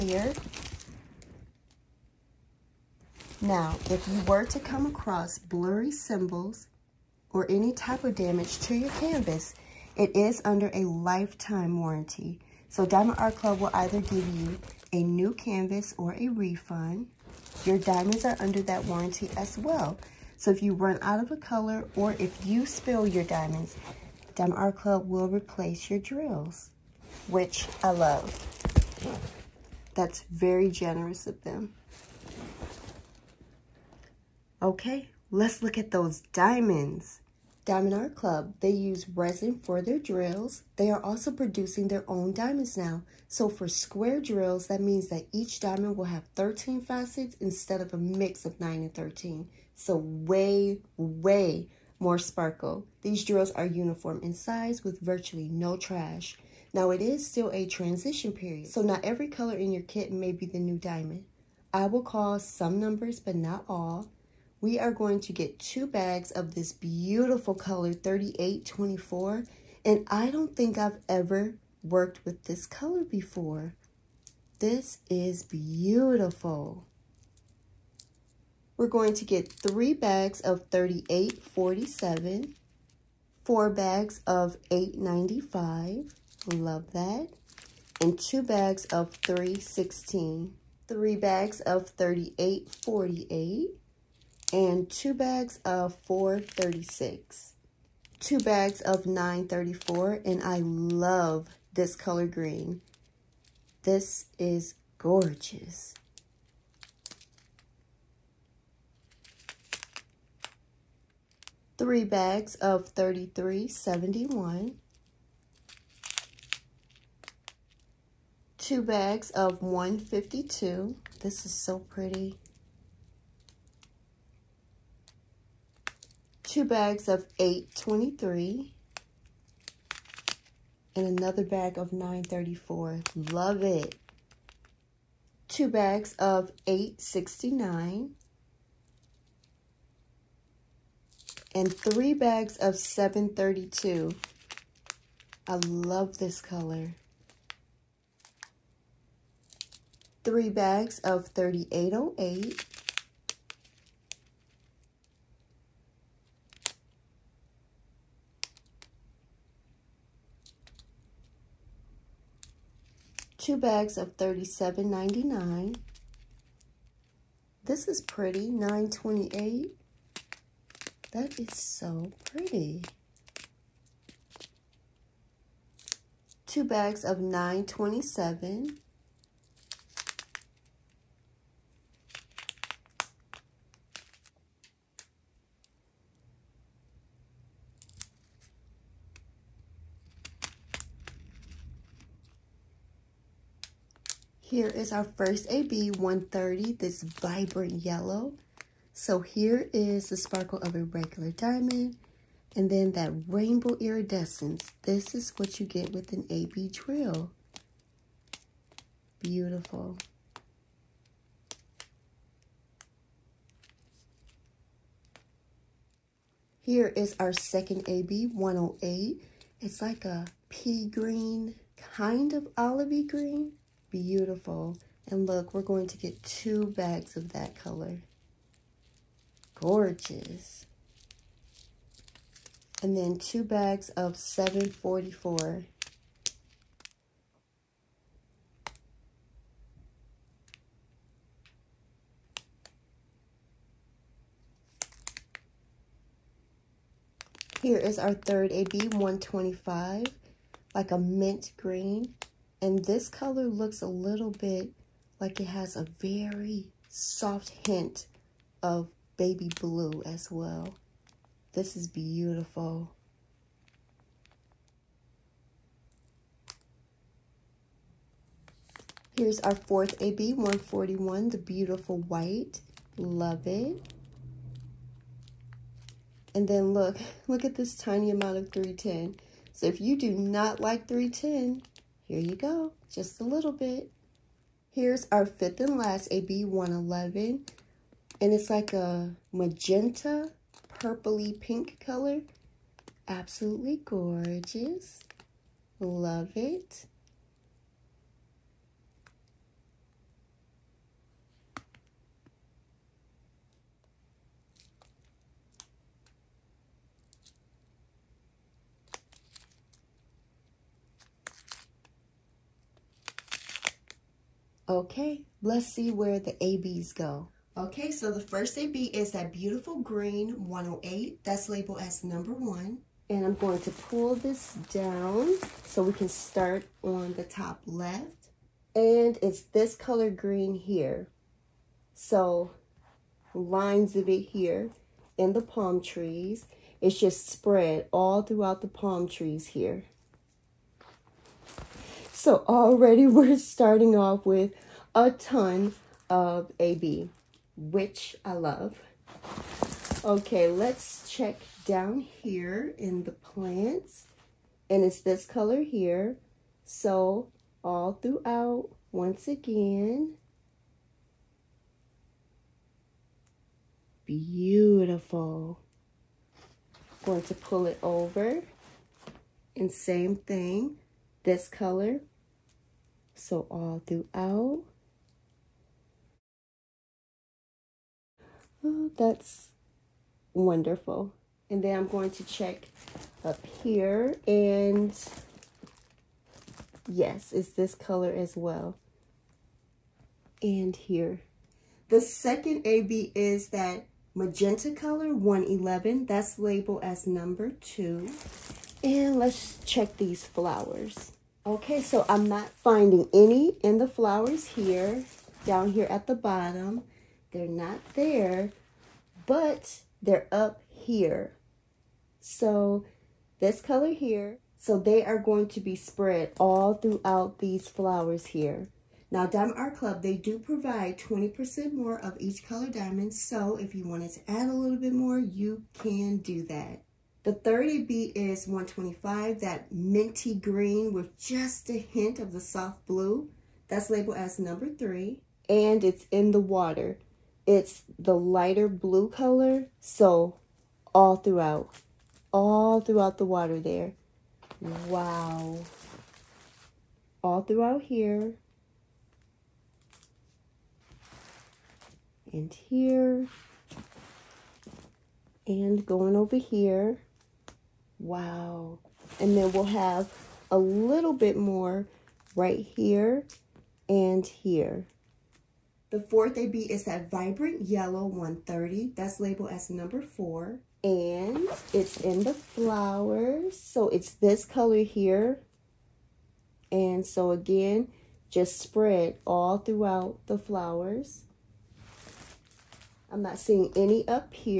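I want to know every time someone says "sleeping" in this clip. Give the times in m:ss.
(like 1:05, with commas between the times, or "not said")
not said.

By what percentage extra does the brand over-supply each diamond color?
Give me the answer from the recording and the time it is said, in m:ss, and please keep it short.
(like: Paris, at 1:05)
20%, at 7:00.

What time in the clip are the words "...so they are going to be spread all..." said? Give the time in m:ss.
6:54.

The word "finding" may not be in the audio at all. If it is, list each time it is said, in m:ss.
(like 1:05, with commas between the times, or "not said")
6:42.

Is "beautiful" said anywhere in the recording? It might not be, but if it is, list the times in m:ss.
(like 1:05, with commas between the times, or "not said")
1:06, 1:15, 3:29, 3:43, 4:21, 4:31, 5:19, 6:04.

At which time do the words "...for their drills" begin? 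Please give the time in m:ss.
0:39.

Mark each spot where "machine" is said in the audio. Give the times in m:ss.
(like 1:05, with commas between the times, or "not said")
not said.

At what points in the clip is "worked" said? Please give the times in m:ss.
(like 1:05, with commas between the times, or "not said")
1:11.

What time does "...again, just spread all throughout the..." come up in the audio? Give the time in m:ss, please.
7:57.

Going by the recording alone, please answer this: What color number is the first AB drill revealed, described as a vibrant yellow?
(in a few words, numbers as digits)
130.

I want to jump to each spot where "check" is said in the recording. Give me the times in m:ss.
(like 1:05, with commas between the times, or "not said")
5:51, 6:22, 6:39.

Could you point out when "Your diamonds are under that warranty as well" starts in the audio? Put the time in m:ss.
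0:17.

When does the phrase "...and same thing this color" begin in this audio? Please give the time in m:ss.
6:09.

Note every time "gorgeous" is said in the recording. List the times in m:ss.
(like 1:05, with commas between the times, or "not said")
1:44, 3:49, 4:53.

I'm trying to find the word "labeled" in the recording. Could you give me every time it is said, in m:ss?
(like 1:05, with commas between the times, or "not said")
5:21, 6:36, 7:13, 7:49.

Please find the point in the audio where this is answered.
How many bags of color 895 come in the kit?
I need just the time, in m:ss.
1:23.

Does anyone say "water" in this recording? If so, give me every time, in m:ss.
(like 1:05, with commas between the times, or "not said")
7:16, 7:23.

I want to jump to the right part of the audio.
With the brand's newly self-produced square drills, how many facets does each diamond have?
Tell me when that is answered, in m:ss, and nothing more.
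0:46.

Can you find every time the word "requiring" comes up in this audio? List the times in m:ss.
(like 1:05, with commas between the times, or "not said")
not said.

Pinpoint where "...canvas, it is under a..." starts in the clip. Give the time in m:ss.
0:08.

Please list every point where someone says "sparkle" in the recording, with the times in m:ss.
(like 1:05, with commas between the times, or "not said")
0:52, 3:20.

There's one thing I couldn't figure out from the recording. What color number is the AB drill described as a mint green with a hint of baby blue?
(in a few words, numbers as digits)
125.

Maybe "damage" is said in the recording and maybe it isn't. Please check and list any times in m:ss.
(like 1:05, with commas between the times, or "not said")
0:08.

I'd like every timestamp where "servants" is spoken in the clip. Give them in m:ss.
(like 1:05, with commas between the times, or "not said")
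not said.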